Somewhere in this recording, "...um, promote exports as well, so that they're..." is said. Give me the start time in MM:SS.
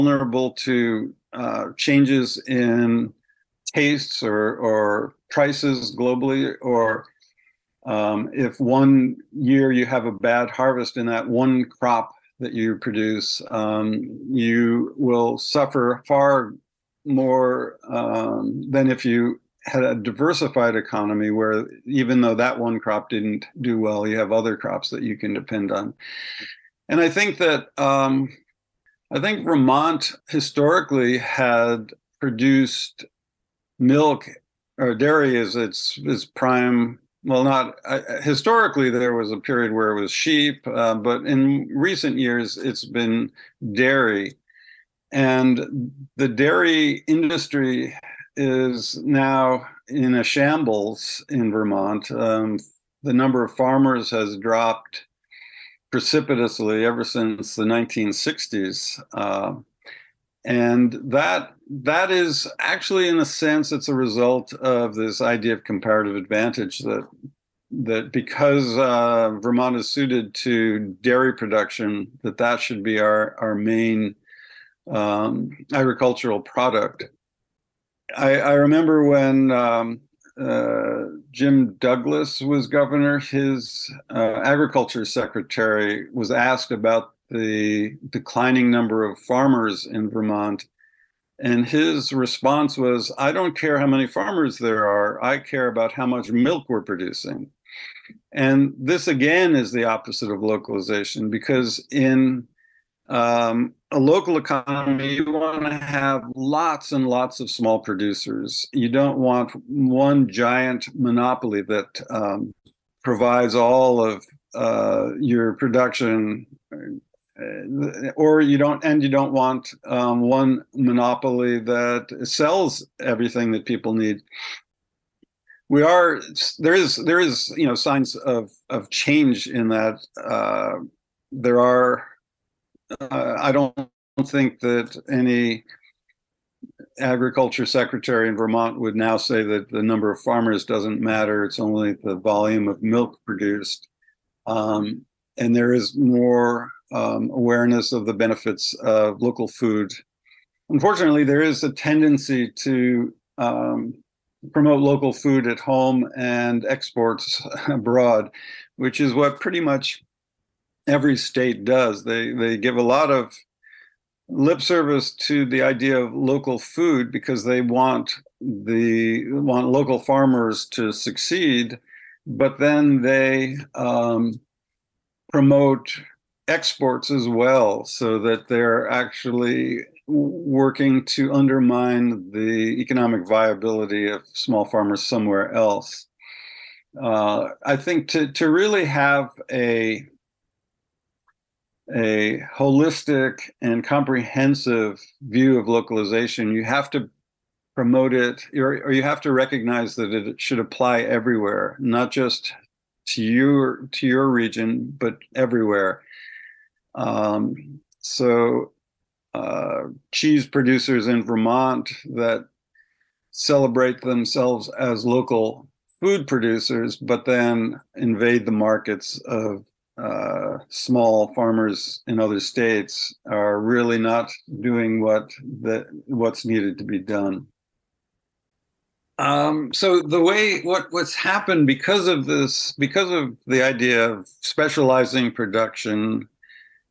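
02:53.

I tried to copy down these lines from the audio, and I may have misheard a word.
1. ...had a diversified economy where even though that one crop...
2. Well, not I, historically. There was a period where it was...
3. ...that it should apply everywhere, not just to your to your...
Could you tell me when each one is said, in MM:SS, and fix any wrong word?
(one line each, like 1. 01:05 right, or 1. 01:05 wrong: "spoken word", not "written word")
1. 00:19 right
2. 00:37 right
3. 03:19 right.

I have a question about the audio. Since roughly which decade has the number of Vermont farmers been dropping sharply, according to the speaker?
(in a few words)
1960s.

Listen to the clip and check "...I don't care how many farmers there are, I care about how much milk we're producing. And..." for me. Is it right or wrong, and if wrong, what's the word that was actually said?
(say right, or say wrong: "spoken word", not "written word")
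right.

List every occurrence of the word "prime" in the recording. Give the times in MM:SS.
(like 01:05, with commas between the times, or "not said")
00:36.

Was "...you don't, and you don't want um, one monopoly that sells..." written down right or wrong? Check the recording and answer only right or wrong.
right.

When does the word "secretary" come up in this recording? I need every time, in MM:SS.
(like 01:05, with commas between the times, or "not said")
01:25, 02:17.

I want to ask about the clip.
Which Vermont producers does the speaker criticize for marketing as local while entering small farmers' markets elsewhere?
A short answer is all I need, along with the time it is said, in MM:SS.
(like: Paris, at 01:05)
Cheese producers, at 03:30.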